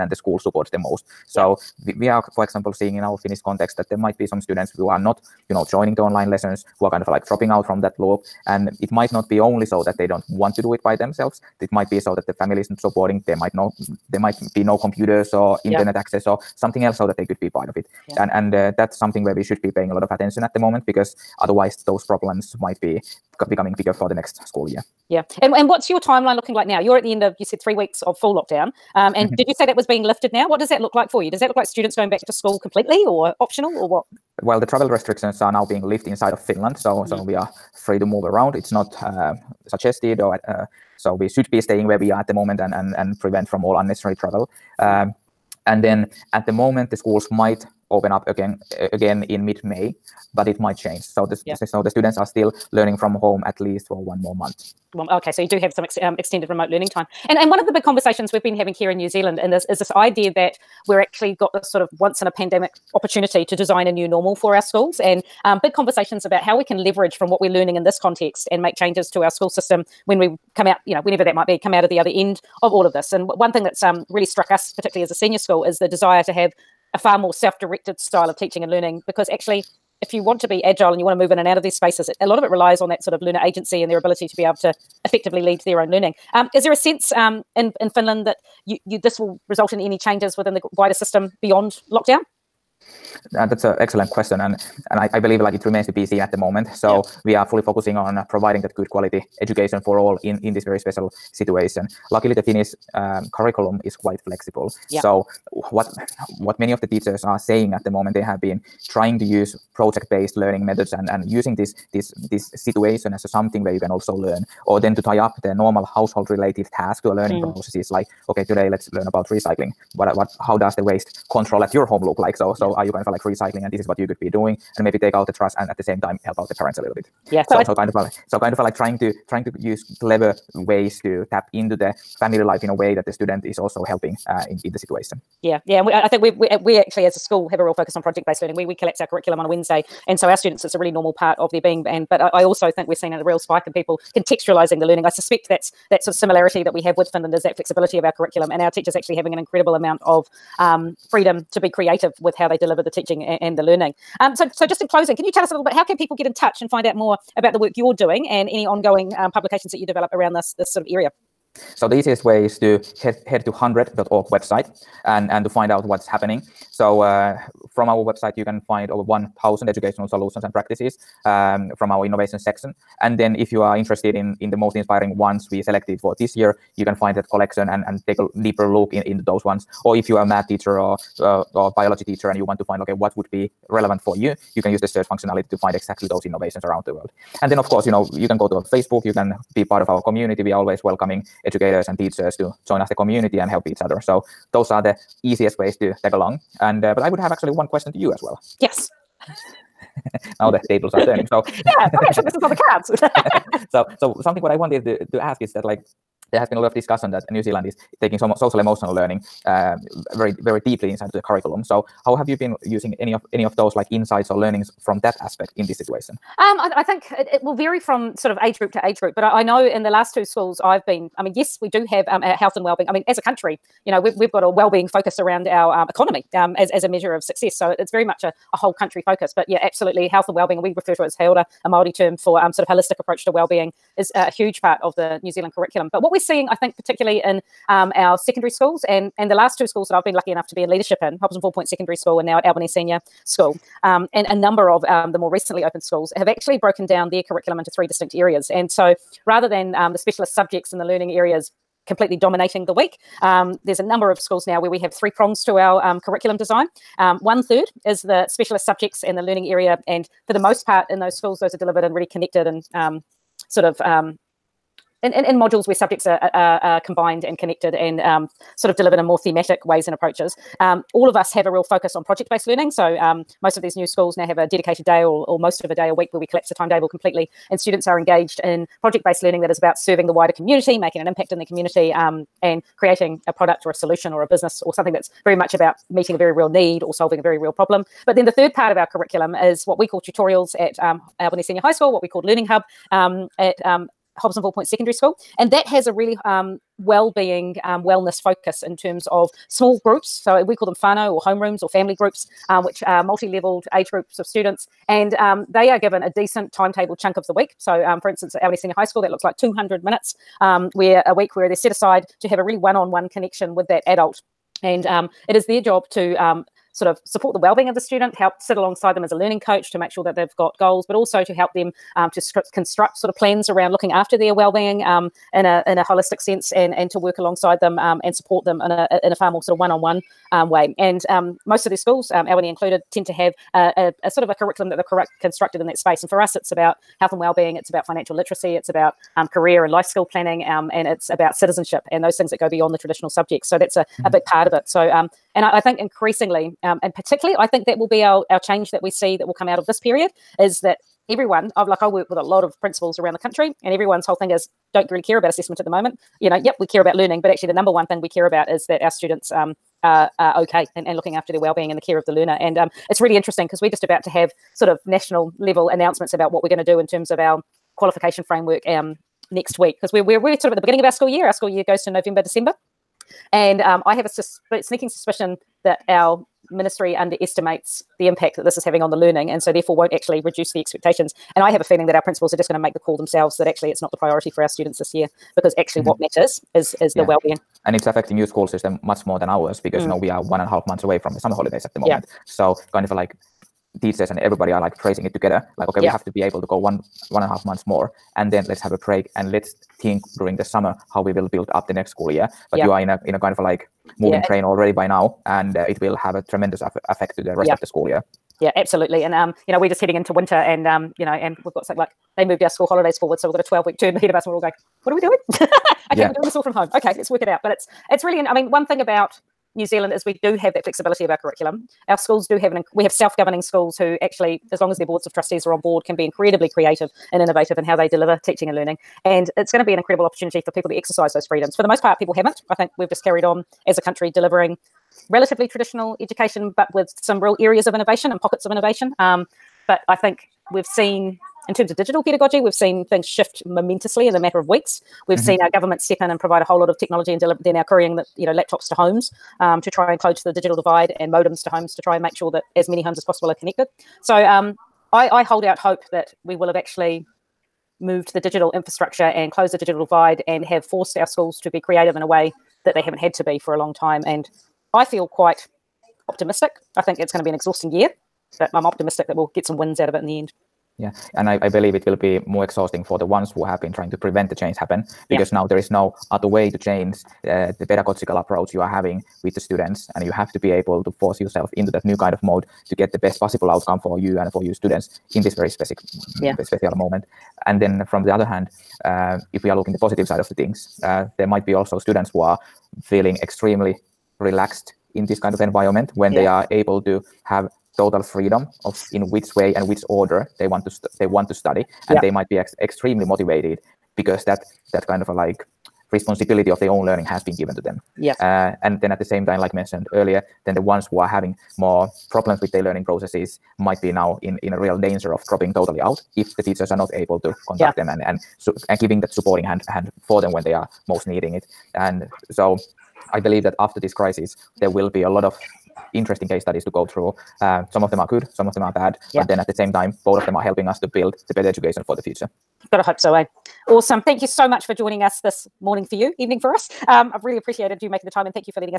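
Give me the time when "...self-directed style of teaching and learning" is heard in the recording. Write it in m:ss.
1:17.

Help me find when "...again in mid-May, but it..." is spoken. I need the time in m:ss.
0:48.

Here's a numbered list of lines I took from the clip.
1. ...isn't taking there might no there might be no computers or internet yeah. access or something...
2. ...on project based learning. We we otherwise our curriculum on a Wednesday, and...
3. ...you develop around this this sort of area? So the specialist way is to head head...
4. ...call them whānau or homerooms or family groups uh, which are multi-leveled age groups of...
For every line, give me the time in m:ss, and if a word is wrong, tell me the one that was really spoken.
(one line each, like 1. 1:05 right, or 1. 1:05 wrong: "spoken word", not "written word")
1. 0:12 wrong: "supporting", not "taking"
2. 2:17 wrong: "collapse", not "otherwise"
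3. 2:39 wrong: "easiest", not "specialist"
4. 5:00 right.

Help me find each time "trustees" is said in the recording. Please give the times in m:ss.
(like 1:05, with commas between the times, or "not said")
7:05.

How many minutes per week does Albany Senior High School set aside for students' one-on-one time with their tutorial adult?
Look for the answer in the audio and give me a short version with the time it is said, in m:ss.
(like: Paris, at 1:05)
200 minutes, at 5:09.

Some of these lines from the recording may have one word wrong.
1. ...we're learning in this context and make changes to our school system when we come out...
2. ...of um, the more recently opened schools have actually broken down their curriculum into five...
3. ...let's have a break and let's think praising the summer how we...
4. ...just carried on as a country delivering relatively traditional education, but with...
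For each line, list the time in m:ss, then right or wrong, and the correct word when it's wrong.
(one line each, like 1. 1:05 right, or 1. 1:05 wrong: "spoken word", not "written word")
1. 1:07 right
2. 4:04 wrong: "three", not "five"
3. 6:38 wrong: "during", not "praising"
4. 7:12 right.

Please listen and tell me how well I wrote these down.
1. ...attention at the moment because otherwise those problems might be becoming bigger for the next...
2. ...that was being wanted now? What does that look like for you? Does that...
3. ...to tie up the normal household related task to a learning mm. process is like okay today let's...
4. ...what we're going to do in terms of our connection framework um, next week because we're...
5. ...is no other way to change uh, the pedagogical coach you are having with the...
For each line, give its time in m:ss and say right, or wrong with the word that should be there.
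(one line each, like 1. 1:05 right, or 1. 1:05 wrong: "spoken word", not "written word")
1. 0:20 right
2. 0:29 wrong: "lifted", not "wanted"
3. 1:54 right
4. 6:06 wrong: "qualification", not "connection"
5. 7:55 wrong: "approach", not "coach".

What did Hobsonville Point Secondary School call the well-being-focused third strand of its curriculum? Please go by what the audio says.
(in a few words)
Learning Hub.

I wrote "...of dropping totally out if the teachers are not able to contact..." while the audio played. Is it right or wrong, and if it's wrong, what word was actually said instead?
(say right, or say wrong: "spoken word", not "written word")
right.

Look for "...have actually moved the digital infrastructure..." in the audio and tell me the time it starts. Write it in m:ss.
7:36.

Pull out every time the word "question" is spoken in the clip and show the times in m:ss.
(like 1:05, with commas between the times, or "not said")
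1:34, 3:17.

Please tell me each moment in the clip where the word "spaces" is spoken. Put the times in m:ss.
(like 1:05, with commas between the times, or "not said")
1:21, 5:35.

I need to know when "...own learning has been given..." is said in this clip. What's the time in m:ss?
8:26.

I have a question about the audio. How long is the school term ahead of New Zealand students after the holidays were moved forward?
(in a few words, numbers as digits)
12 weeks.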